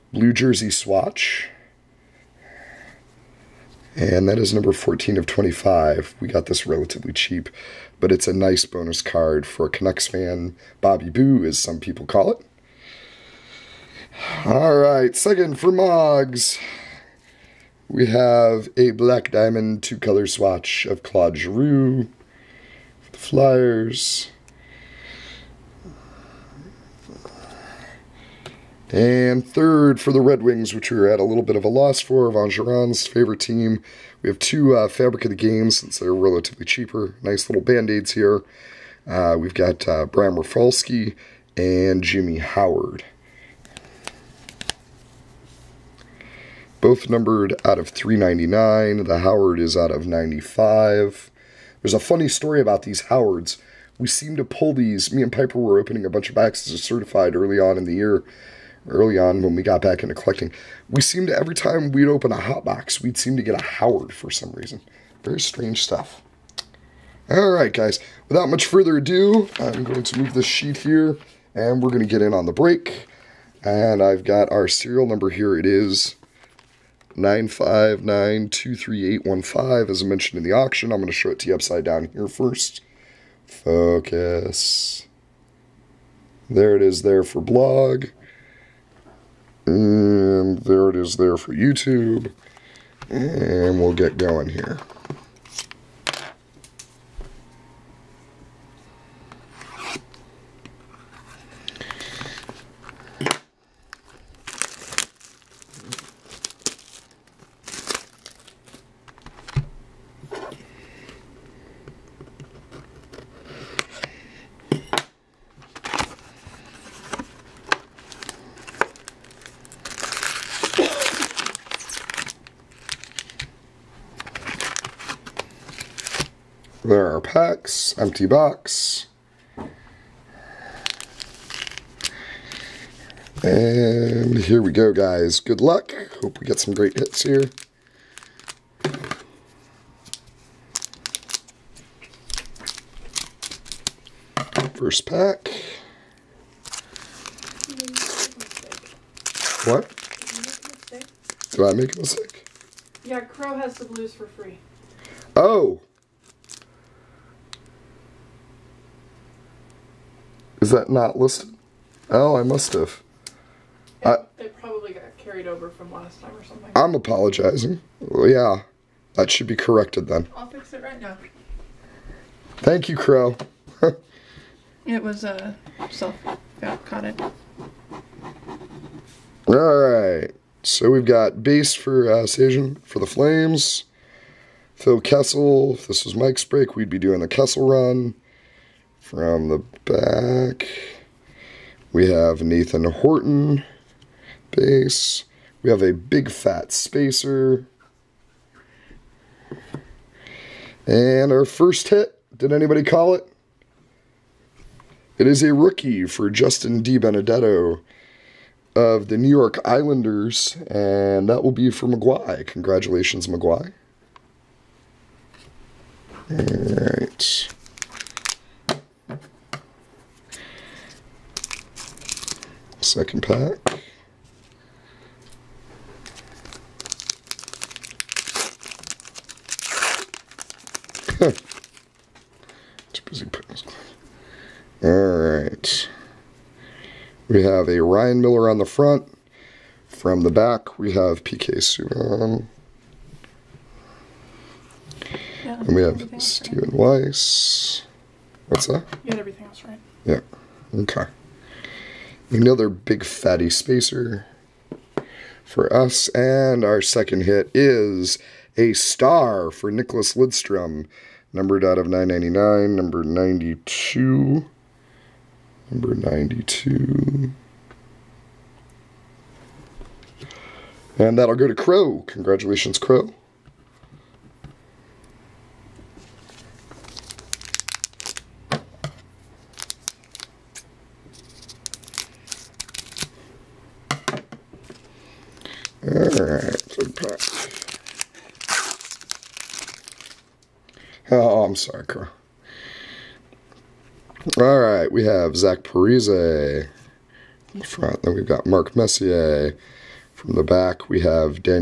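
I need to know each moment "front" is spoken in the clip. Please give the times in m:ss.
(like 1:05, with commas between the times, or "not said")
3:58, 4:57.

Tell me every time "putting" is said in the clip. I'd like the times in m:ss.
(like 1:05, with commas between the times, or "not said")
3:53.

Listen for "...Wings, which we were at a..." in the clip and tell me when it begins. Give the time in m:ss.
0:30.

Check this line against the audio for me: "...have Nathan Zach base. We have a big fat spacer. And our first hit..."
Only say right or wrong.
wrong.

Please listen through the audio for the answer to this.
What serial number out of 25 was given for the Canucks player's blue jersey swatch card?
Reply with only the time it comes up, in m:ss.
0:04.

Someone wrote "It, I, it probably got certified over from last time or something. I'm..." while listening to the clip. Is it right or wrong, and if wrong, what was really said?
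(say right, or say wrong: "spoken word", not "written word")
wrong: "carried", not "certified".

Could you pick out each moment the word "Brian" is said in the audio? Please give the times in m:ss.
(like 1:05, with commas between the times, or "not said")
0:40.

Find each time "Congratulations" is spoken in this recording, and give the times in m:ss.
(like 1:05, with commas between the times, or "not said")
3:32, 4:32.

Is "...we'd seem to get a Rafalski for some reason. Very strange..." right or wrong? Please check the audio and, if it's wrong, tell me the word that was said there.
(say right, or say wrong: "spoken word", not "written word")
wrong: "Howard", not "Rafalski".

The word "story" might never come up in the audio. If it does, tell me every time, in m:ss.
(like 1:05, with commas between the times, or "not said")
0:52.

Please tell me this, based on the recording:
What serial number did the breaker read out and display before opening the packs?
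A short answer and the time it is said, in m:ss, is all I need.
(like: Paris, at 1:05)
23815, at 1:17.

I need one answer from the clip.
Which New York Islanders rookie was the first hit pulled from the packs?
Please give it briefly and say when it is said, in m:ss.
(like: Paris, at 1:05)
Justin DiBenedetto, at 3:26.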